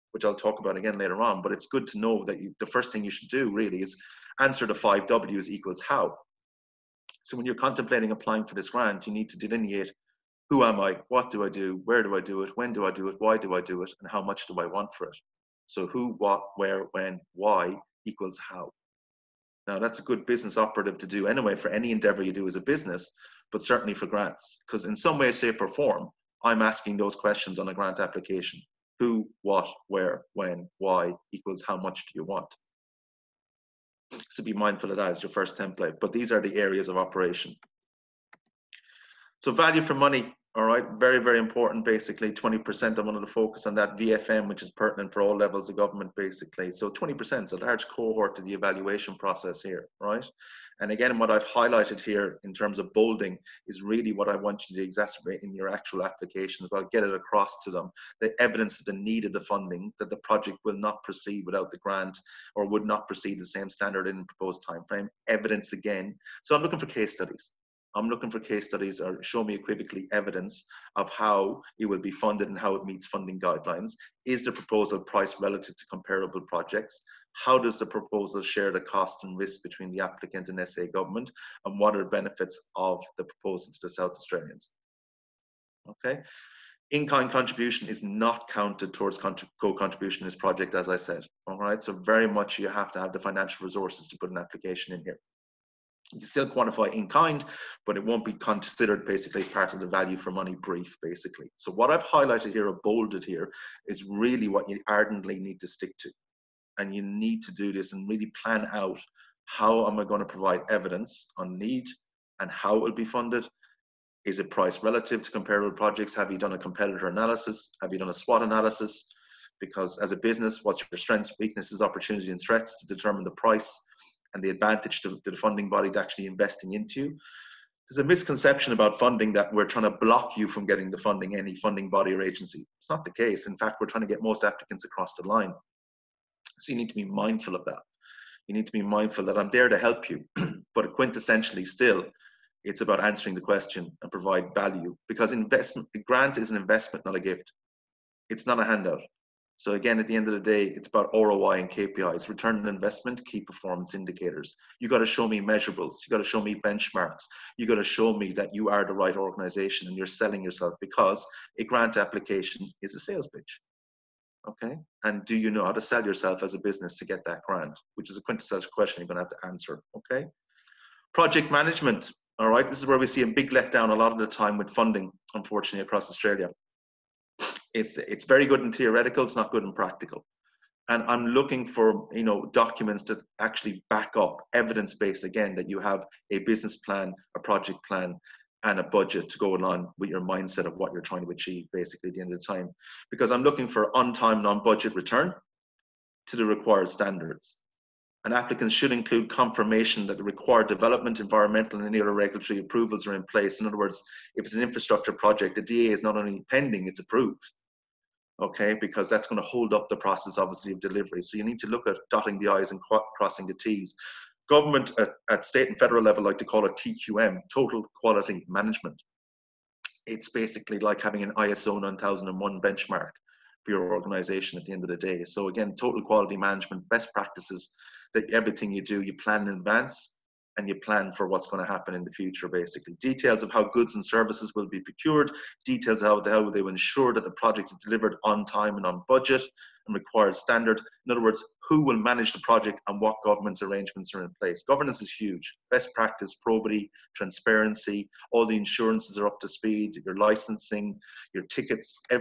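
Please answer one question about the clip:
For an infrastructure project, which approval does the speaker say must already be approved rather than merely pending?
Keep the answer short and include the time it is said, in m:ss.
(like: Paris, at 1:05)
DA, at 3:25.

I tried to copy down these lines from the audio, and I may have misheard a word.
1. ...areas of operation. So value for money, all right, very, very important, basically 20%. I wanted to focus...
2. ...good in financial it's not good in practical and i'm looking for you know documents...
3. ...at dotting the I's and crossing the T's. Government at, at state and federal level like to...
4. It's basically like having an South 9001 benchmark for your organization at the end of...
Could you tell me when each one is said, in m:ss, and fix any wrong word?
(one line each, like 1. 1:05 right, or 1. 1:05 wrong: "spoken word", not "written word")
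1. 0:36 right
2. 2:58 wrong: "theoretical", not "financial"
3. 3:31 right
4. 3:40 wrong: "ISO", not "South".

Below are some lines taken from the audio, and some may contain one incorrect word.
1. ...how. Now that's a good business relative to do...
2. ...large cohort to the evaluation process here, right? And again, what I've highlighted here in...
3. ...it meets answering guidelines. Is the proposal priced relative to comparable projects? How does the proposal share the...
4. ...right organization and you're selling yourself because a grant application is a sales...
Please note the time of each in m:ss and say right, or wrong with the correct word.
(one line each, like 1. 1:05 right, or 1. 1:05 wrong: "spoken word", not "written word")
1. 0:18 wrong: "operative", not "relative"
2. 0:47 right
3. 1:12 wrong: "funding", not "answering"
4. 2:38 right.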